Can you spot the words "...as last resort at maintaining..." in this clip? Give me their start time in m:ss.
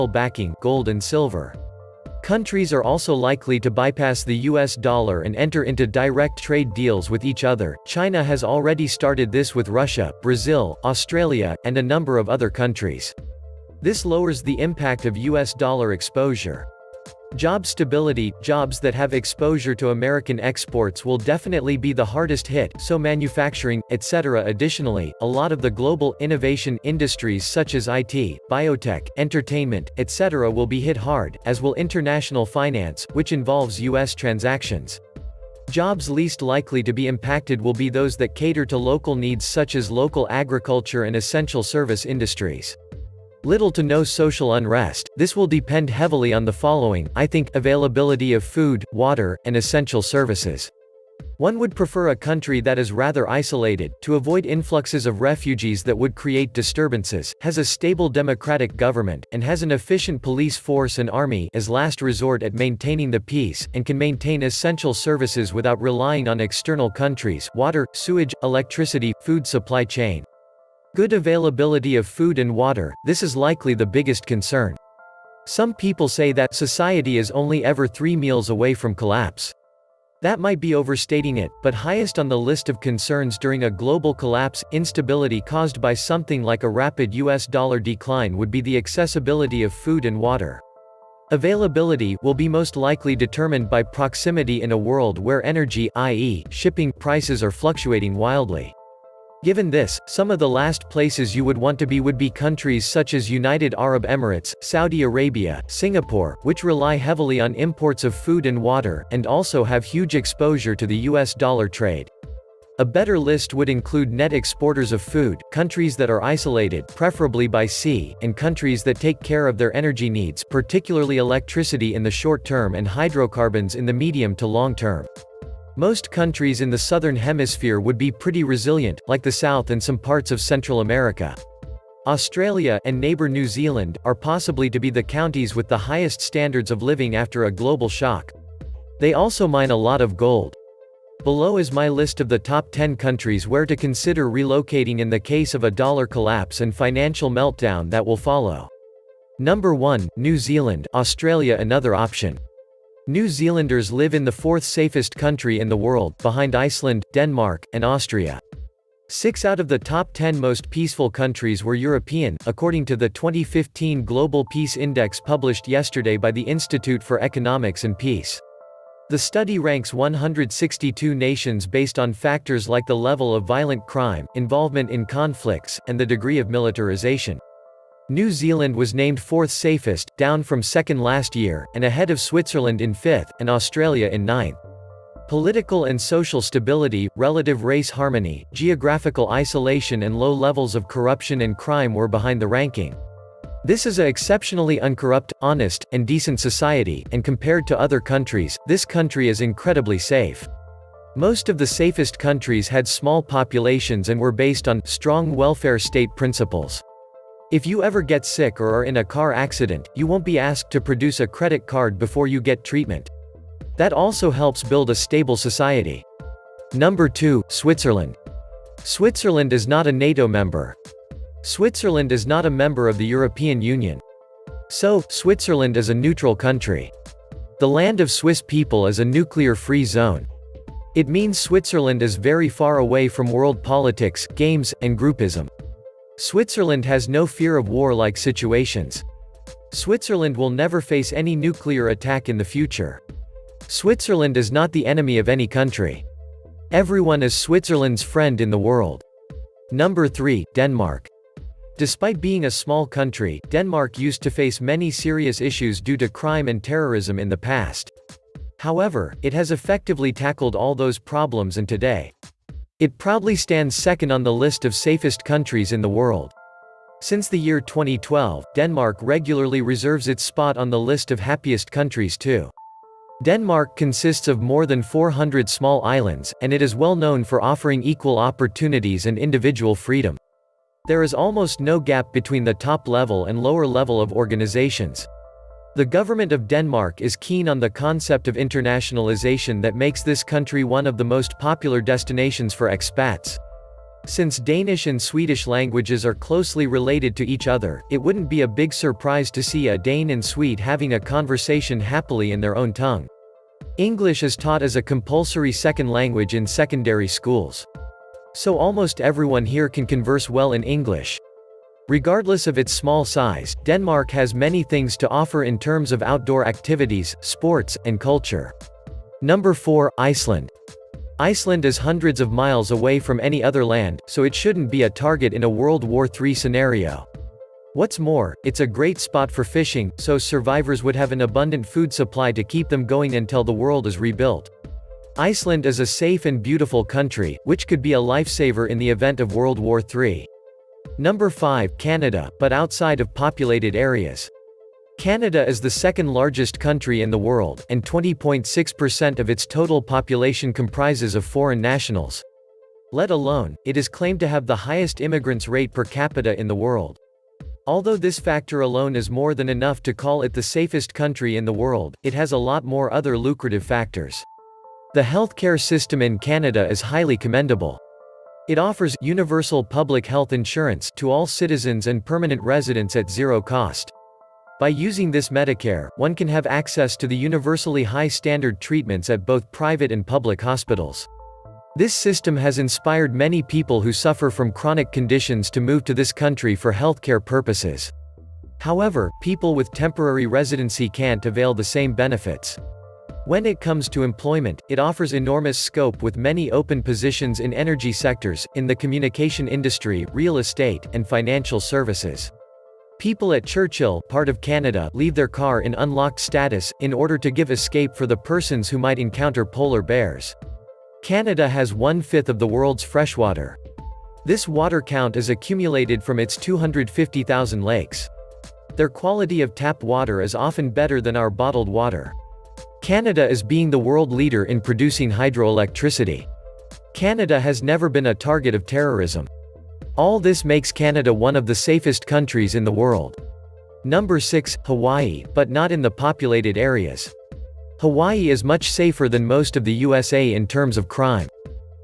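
1:01.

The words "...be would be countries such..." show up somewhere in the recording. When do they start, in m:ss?
1:41.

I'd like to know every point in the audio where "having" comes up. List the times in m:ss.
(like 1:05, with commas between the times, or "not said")
5:00.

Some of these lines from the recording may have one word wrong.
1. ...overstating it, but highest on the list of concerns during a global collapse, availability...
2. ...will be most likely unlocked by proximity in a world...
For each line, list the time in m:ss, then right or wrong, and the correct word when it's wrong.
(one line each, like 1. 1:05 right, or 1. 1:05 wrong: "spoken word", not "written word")
1. 1:20 wrong: "instability", not "availability"
2. 1:32 wrong: "determined", not "unlocked".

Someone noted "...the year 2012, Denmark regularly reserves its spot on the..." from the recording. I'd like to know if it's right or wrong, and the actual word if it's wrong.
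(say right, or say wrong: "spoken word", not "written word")
right.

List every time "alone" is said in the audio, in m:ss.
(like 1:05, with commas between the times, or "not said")
5:53, 5:58.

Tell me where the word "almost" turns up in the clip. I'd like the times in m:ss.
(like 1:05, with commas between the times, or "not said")
4:41, 5:08.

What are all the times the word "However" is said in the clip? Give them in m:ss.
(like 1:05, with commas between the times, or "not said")
4:18, 6:28.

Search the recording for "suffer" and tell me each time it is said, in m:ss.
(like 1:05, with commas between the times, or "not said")
6:23.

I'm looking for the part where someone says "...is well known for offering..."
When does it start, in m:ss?
4:36.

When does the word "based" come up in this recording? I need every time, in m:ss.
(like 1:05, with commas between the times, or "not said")
2:51, 3:24.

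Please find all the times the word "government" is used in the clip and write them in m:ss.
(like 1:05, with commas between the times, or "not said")
0:58, 4:45.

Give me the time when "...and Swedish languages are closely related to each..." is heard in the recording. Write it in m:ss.
4:54.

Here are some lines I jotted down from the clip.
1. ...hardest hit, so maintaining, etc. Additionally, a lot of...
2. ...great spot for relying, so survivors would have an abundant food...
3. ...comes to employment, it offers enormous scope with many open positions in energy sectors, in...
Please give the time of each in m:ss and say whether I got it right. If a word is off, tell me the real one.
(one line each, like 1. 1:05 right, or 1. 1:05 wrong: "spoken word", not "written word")
1. 0:22 wrong: "manufacturing", not "maintaining"
2. 5:28 wrong: "fishing", not "relying"
3. 6:33 right.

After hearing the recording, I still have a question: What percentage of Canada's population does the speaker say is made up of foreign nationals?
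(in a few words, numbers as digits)
20.6%.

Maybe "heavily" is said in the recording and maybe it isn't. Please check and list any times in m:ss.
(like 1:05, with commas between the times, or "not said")
0:45, 1:46.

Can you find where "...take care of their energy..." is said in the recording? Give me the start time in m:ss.
1:58.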